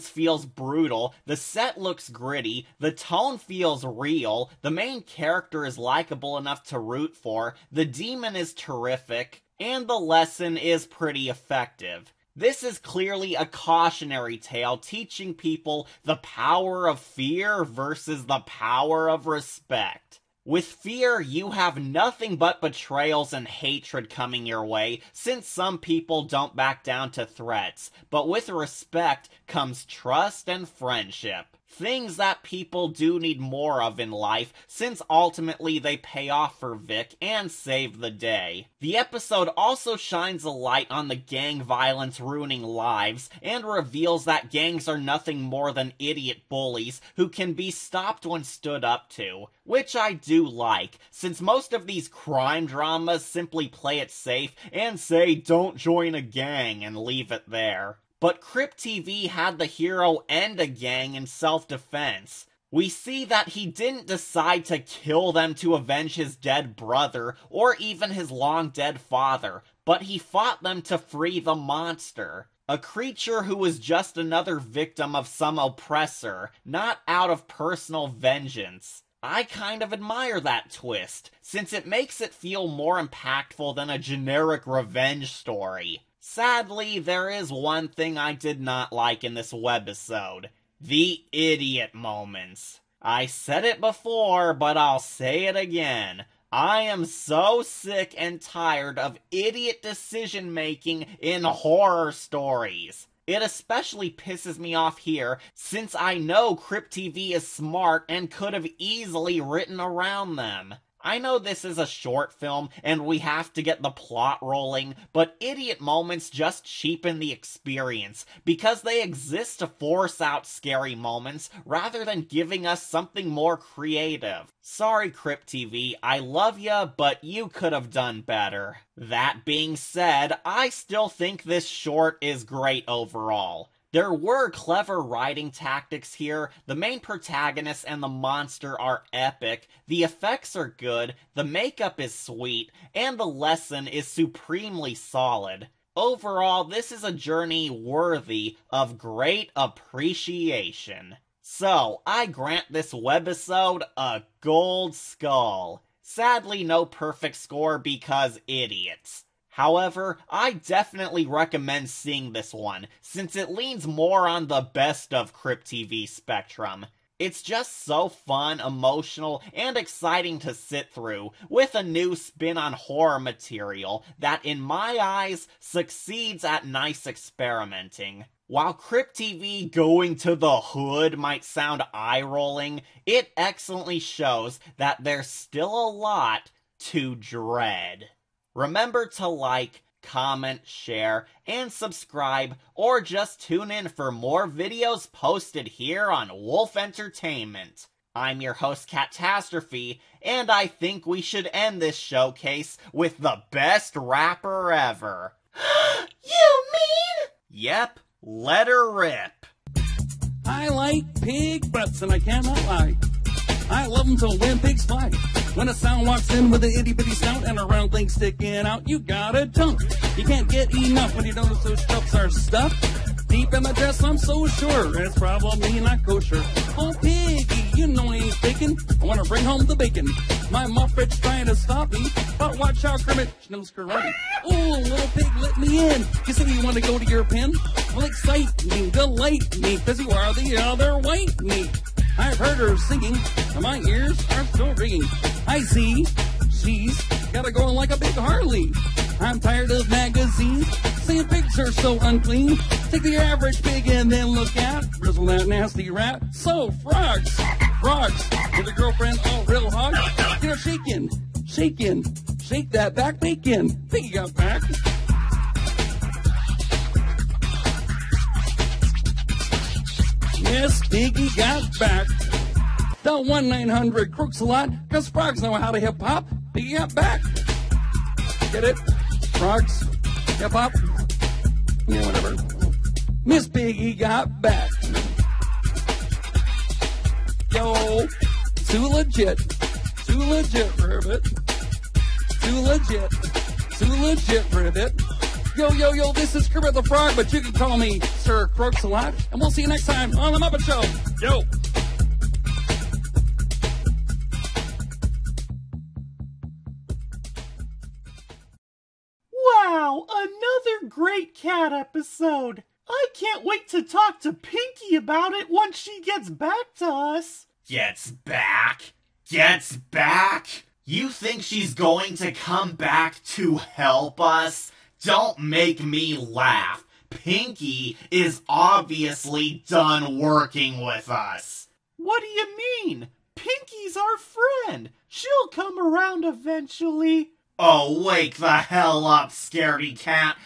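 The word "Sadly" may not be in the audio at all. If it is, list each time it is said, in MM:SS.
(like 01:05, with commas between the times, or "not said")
01:26, 02:36.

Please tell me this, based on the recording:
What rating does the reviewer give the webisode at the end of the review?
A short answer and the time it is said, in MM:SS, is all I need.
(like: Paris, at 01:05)
gold skull, at 02:34.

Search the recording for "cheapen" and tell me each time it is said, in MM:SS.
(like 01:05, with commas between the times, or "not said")
01:56.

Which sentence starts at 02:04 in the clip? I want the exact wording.
Sorry, Crypt TV, I love ya, but you could have done better.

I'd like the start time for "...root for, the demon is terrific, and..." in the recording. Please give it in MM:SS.
00:06.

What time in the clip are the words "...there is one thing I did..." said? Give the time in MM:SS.
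01:26.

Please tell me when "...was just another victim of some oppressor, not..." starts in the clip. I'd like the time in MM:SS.
01:13.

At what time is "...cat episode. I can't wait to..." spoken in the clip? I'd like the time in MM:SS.
05:11.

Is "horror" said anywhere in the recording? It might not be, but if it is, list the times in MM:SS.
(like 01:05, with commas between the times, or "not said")
01:41, 02:52.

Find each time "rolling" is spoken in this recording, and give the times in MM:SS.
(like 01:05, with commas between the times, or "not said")
01:54, 03:02.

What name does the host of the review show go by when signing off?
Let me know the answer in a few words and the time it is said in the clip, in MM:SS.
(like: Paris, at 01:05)
Catastrophe, at 03:18.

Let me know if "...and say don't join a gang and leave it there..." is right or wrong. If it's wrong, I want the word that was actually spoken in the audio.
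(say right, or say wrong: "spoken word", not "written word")
right.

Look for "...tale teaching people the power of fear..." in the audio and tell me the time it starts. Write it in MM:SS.
00:14.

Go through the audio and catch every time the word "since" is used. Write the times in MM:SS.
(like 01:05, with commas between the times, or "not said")
00:25, 00:34, 00:51, 01:21, 01:45, 02:42.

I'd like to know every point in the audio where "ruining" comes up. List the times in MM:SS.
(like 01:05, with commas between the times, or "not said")
00:42.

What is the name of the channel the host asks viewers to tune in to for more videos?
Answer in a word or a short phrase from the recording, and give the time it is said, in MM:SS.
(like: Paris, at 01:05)
Wolf Entertainment, at 03:16.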